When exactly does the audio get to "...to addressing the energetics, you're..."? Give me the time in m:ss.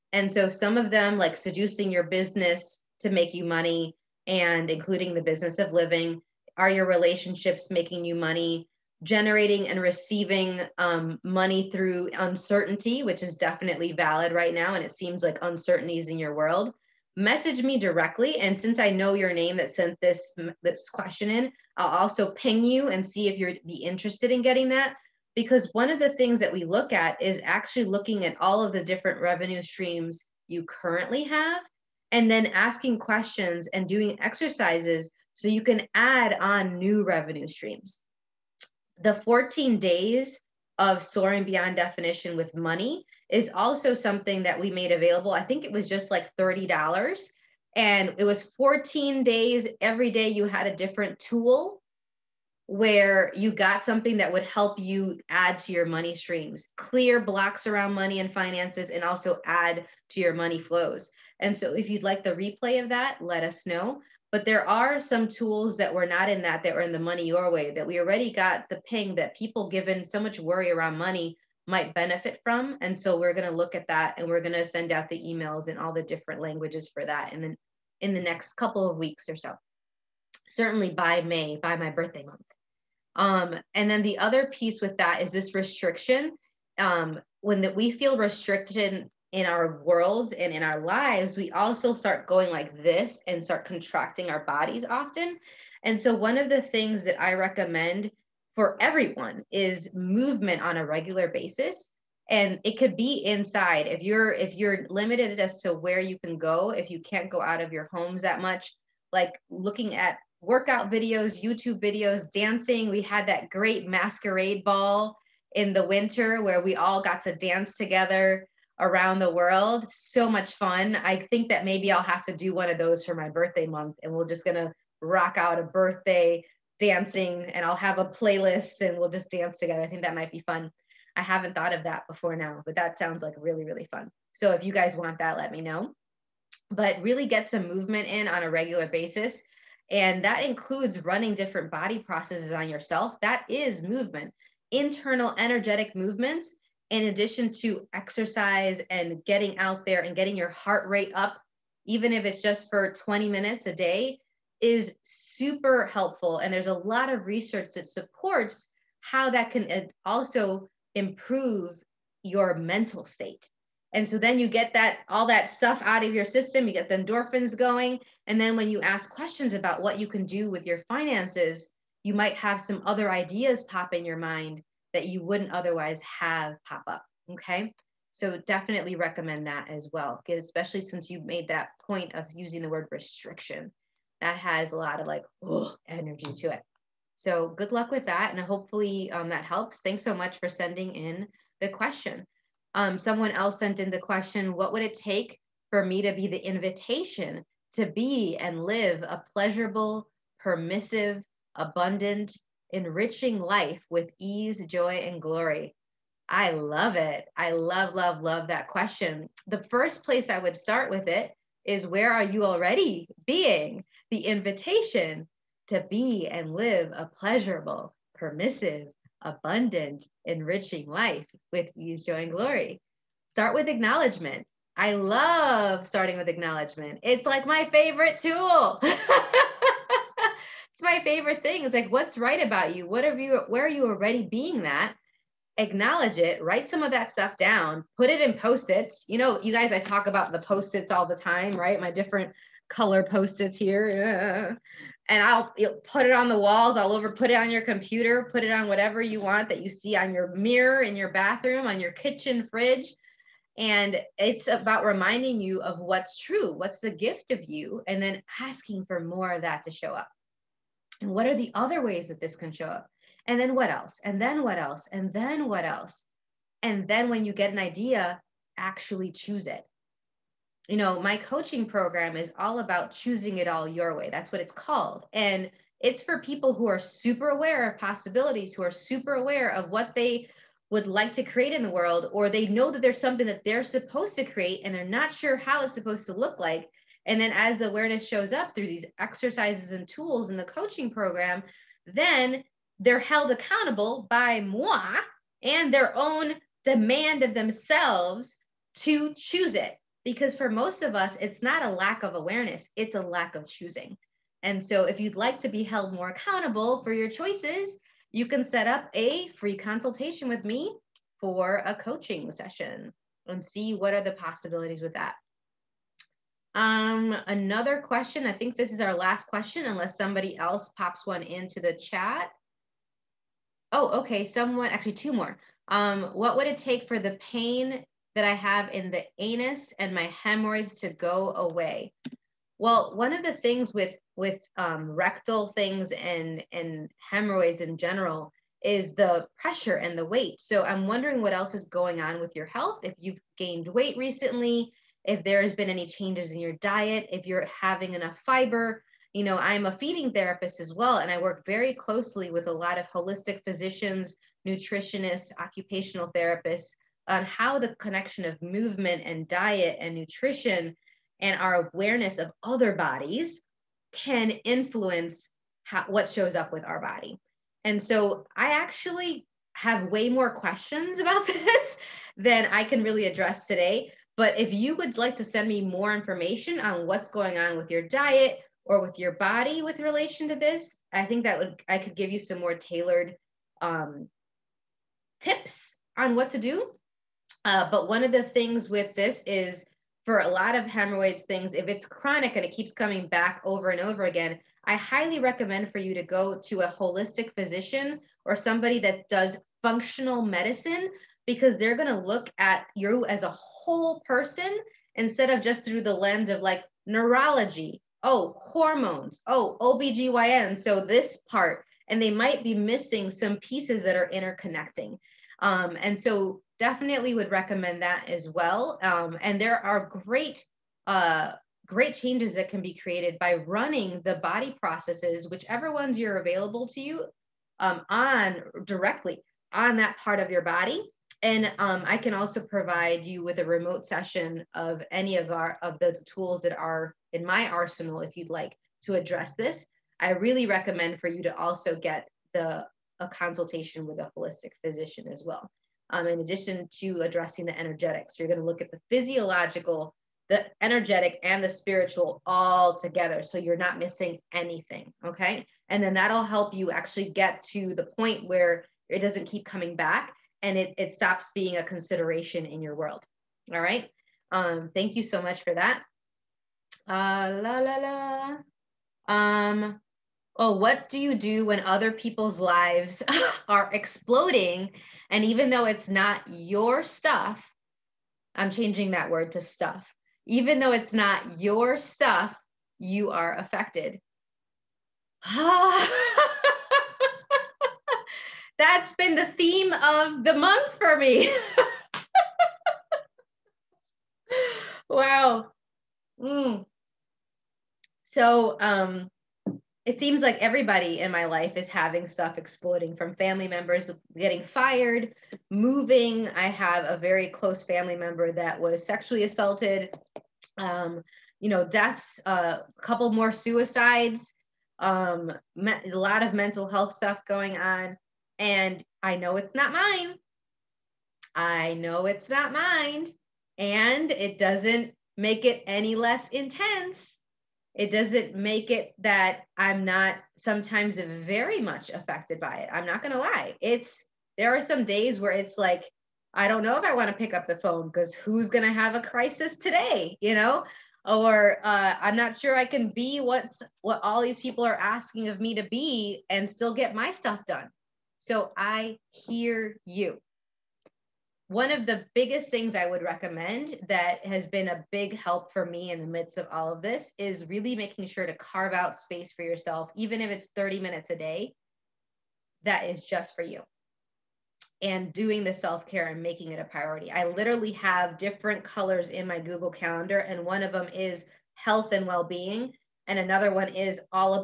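7:26.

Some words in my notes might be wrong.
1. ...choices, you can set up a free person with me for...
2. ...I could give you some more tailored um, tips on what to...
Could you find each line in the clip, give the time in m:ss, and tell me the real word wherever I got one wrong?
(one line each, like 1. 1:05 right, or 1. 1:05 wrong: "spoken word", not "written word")
1. 5:07 wrong: "consultation", not "person"
2. 6:21 right.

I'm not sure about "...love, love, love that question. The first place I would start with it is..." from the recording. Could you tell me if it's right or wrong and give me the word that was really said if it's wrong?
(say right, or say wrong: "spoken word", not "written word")
right.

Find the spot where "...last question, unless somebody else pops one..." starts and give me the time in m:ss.
5:18.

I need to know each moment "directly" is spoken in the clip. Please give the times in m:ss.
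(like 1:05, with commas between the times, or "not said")
0:17, 7:08.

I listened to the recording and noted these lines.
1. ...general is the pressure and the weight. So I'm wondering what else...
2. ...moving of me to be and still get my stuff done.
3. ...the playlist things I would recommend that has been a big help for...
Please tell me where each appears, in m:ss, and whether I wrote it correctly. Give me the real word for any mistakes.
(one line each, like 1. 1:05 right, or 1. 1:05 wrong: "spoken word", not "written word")
1. 5:37 right
2. 9:04 wrong: "asking", not "moving"
3. 9:11 wrong: "biggest", not "playlist".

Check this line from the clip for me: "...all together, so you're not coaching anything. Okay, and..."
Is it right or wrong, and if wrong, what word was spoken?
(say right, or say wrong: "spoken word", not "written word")
wrong: "missing", not "coaching".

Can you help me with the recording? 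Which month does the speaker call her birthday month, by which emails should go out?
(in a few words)
May.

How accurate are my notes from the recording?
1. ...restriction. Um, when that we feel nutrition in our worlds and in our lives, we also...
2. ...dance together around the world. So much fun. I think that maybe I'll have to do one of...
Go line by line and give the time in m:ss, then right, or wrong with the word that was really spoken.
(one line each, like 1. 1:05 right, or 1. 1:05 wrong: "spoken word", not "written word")
1. 1:25 wrong: "restriction", not "nutrition"
2. 1:57 right.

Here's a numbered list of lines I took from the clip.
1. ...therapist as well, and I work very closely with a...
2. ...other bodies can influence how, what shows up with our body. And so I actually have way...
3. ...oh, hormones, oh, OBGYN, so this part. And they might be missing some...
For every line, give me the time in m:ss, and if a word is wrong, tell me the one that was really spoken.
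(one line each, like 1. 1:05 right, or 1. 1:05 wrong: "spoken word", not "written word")
1. 5:50 right
2. 6:02 right
3. 6:48 right.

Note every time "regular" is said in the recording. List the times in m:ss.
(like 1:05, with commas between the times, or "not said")
1:40, 2:18.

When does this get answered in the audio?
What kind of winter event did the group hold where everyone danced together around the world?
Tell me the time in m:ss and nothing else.
1:53.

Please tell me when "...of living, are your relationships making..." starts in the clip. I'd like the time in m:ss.
0:05.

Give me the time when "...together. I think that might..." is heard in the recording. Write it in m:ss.
2:09.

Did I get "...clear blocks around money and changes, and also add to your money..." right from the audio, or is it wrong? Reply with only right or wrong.
wrong.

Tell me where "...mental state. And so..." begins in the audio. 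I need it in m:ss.
2:42.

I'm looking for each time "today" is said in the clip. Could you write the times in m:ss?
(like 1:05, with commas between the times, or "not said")
6:13, 8:59.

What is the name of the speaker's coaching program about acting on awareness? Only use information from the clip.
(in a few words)
Choosing It All Your Way.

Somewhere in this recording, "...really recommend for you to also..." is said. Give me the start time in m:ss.
7:20.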